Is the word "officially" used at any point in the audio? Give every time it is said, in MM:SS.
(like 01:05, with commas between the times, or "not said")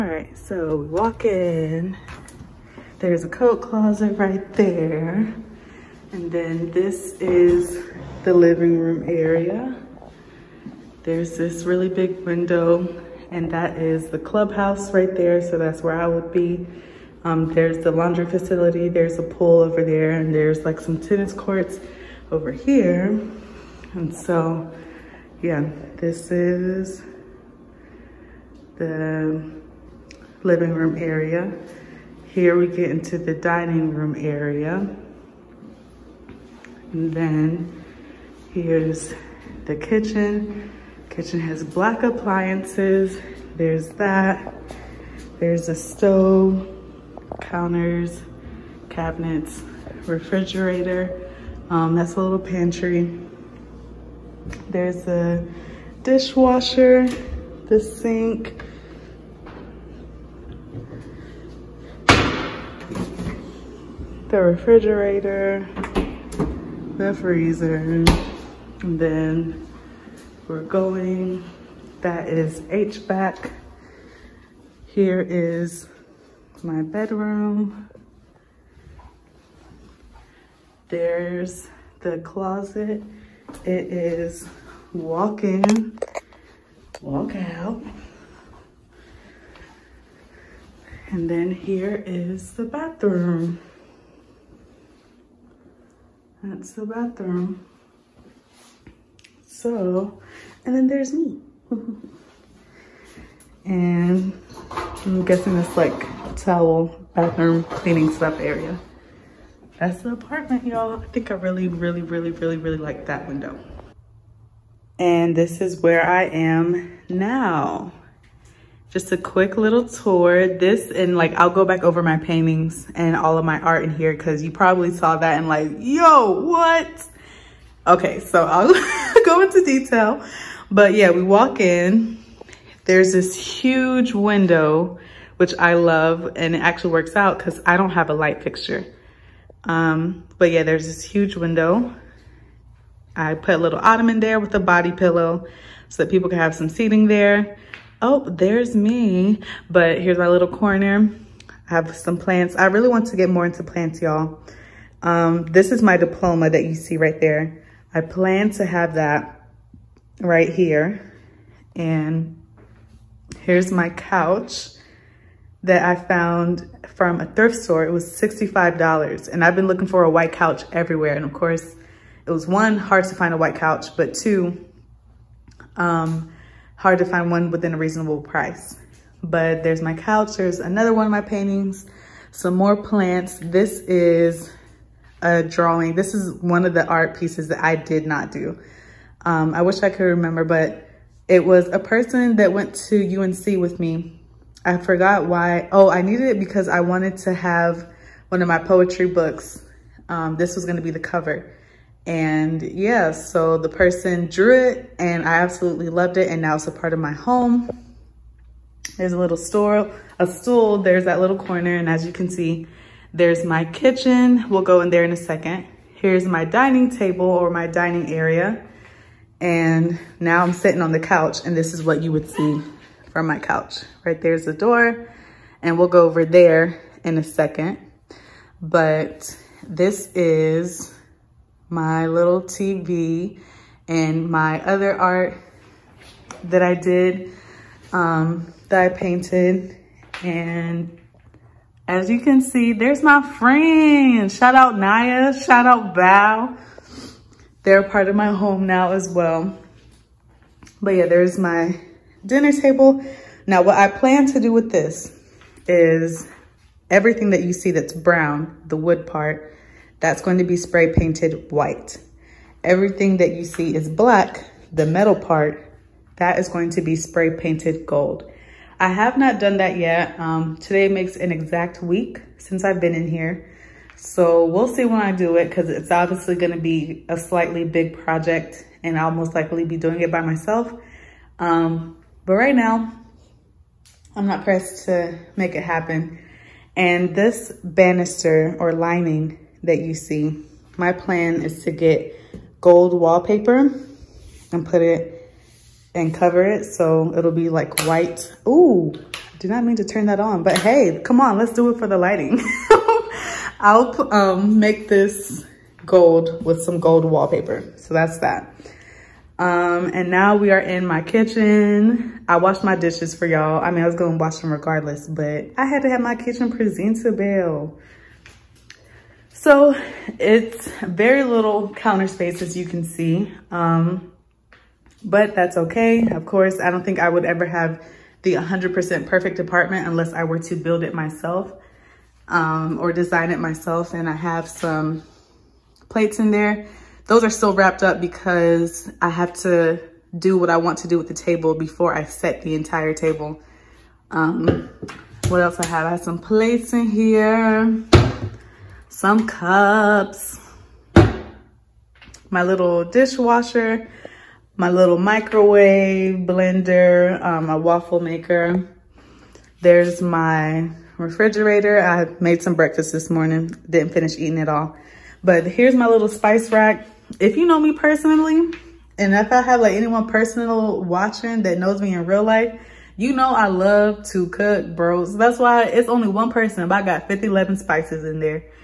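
not said.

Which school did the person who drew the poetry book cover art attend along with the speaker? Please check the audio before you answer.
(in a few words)
UNC.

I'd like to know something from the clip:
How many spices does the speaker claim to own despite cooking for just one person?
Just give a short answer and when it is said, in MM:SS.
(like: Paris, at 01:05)
511, at 06:17.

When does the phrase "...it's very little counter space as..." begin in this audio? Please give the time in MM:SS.
05:20.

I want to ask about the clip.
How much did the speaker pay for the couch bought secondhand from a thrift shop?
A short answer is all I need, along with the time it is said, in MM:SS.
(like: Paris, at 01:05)
$65, at 02:48.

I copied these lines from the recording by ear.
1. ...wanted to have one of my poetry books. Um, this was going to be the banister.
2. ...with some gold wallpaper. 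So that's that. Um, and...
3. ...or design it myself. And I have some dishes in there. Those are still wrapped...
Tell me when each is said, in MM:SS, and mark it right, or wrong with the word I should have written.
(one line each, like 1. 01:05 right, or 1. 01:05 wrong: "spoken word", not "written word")
1. 03:16 wrong: "cover", not "banister"
2. 05:06 right
3. 05:32 wrong: "plates", not "dishes".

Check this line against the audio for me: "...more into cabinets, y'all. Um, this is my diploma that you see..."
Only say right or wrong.
wrong.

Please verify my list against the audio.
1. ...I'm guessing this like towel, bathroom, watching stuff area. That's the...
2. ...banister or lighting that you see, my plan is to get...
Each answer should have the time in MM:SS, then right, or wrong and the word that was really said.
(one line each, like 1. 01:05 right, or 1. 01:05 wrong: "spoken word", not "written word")
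1. 01:45 wrong: "cleaning", not "watching"
2. 04:47 wrong: "lining", not "lighting".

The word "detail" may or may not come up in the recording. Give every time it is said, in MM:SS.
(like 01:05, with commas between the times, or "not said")
02:09.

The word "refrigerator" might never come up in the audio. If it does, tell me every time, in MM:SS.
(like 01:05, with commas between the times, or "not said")
00:50, 01:04, 06:01.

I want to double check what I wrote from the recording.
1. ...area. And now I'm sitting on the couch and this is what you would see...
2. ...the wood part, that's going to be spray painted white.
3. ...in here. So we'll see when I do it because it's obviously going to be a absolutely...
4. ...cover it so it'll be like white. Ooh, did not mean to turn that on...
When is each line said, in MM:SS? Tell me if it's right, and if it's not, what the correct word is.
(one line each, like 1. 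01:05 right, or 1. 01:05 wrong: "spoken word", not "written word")
1. 03:38 right
2. 04:18 right
3. 04:32 wrong: "slightly", not "absolutely"
4. 04:56 right.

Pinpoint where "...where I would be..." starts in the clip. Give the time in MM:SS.
00:15.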